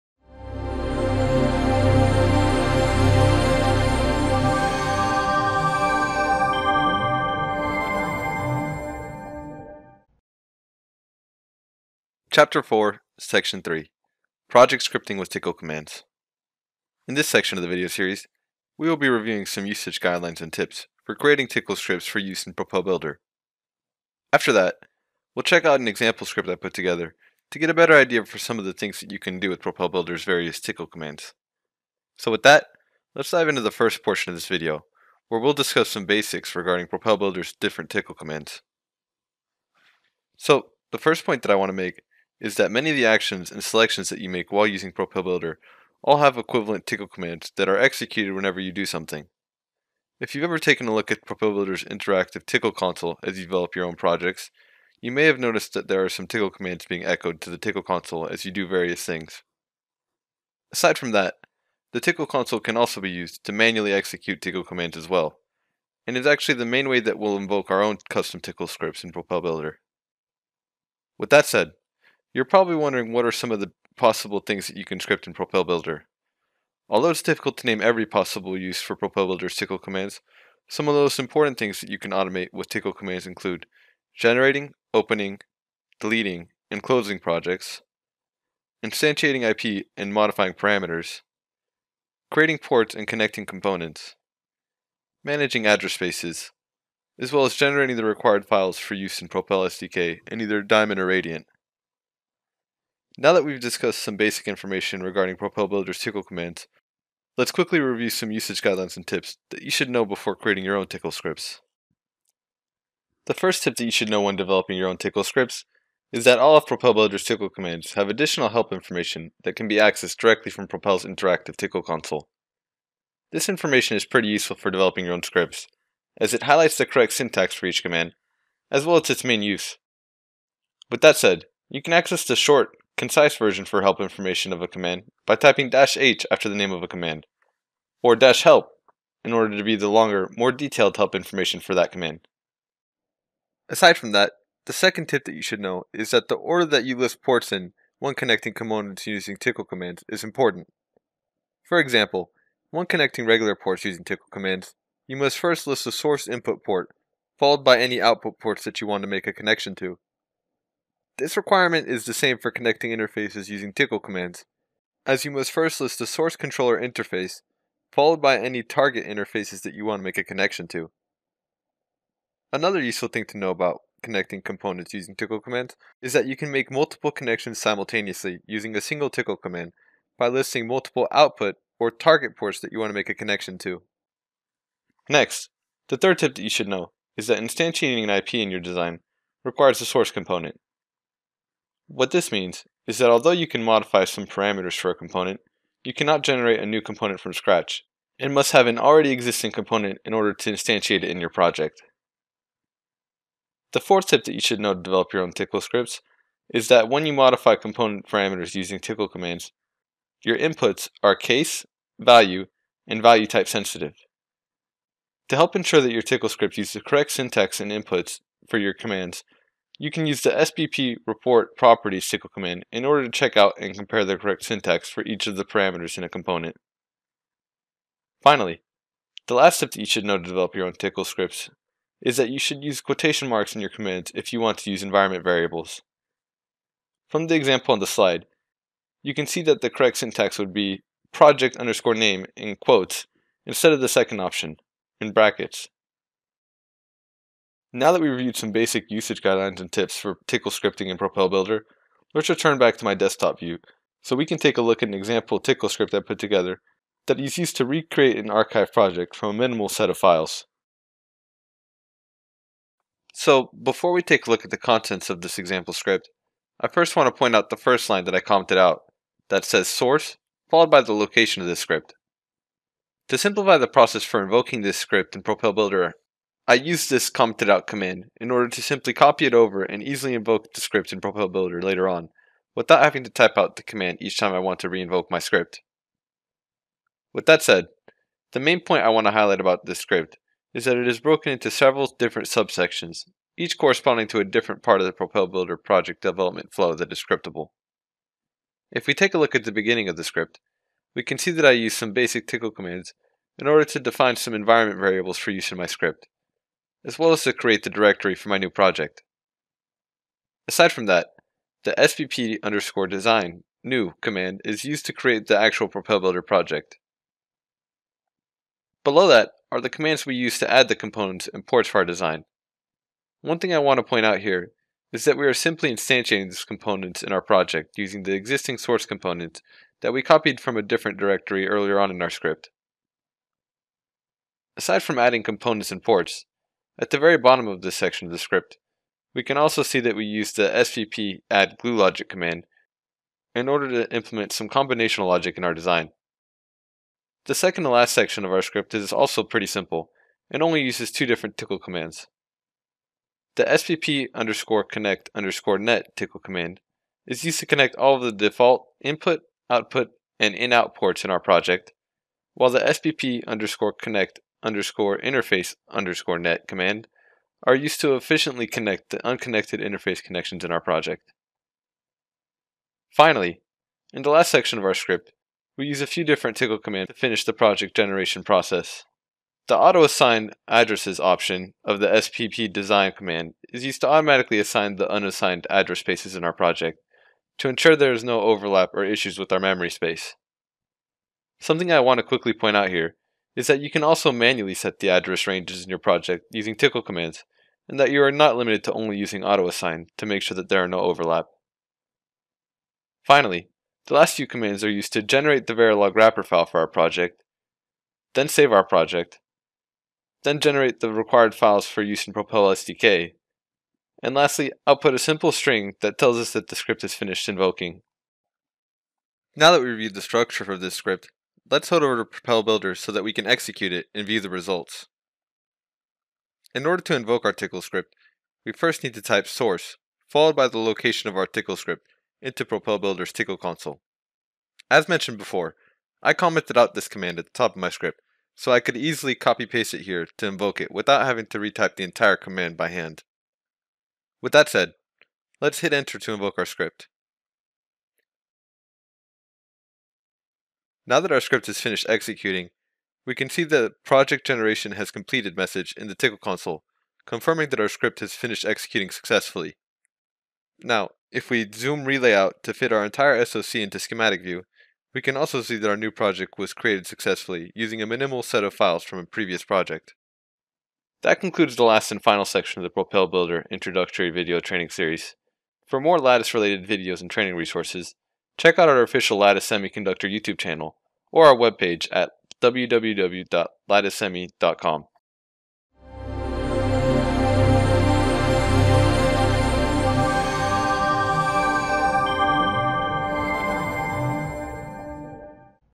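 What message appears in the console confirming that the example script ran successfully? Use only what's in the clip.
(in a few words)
project generation has completed.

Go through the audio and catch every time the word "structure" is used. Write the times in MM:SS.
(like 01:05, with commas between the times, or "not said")
07:00.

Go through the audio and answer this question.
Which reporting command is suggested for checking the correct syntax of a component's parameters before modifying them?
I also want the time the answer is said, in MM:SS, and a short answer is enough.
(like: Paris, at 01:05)
SBP report property SQL, at 03:40.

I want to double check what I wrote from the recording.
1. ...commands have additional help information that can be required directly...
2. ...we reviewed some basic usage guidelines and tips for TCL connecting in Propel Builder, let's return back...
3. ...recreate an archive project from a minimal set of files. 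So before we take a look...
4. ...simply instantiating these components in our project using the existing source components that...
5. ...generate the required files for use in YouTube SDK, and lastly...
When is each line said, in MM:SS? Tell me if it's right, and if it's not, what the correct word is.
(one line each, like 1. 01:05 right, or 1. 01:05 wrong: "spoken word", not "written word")
1. 01:57 wrong: "accessed", not "required"
2. 04:08 wrong: "scripting", not "connecting"
3. 04:17 right
4. 05:25 right
5. 06:50 wrong: "Propel", not "YouTube".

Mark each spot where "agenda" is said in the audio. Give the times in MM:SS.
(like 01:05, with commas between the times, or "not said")
not said.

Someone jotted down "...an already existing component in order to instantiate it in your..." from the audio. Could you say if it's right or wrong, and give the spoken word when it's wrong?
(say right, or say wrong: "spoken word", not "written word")
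right.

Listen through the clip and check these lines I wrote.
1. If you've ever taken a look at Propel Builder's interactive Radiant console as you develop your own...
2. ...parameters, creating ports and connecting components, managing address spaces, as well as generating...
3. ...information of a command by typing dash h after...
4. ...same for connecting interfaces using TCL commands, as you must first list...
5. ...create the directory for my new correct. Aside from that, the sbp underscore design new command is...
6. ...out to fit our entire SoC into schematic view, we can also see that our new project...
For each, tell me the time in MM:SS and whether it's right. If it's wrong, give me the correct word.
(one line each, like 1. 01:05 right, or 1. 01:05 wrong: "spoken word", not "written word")
1. 00:50 wrong: "TCL", not "Radiant"
2. 01:30 right
3. 02:13 right
4. 02:42 right
5. 05:07 wrong: "project", not "correct"
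6. 07:42 right.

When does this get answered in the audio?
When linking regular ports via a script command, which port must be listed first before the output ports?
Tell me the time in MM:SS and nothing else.
02:35.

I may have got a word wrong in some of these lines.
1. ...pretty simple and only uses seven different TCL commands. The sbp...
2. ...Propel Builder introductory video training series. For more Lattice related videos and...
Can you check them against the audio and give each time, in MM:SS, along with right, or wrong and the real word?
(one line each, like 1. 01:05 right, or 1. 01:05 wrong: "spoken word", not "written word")
1. 05:49 wrong: "two", not "seven"
2. 07:52 right.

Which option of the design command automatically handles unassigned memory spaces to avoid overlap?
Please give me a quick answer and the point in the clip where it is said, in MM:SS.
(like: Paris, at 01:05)
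auto-assign addresses, at 06:19.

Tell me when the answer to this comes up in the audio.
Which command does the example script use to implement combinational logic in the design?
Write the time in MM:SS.
05:40.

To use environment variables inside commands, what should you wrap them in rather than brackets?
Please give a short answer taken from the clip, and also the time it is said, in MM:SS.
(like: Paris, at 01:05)
quotation marks, at 03:52.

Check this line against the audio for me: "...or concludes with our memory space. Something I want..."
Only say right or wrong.
wrong.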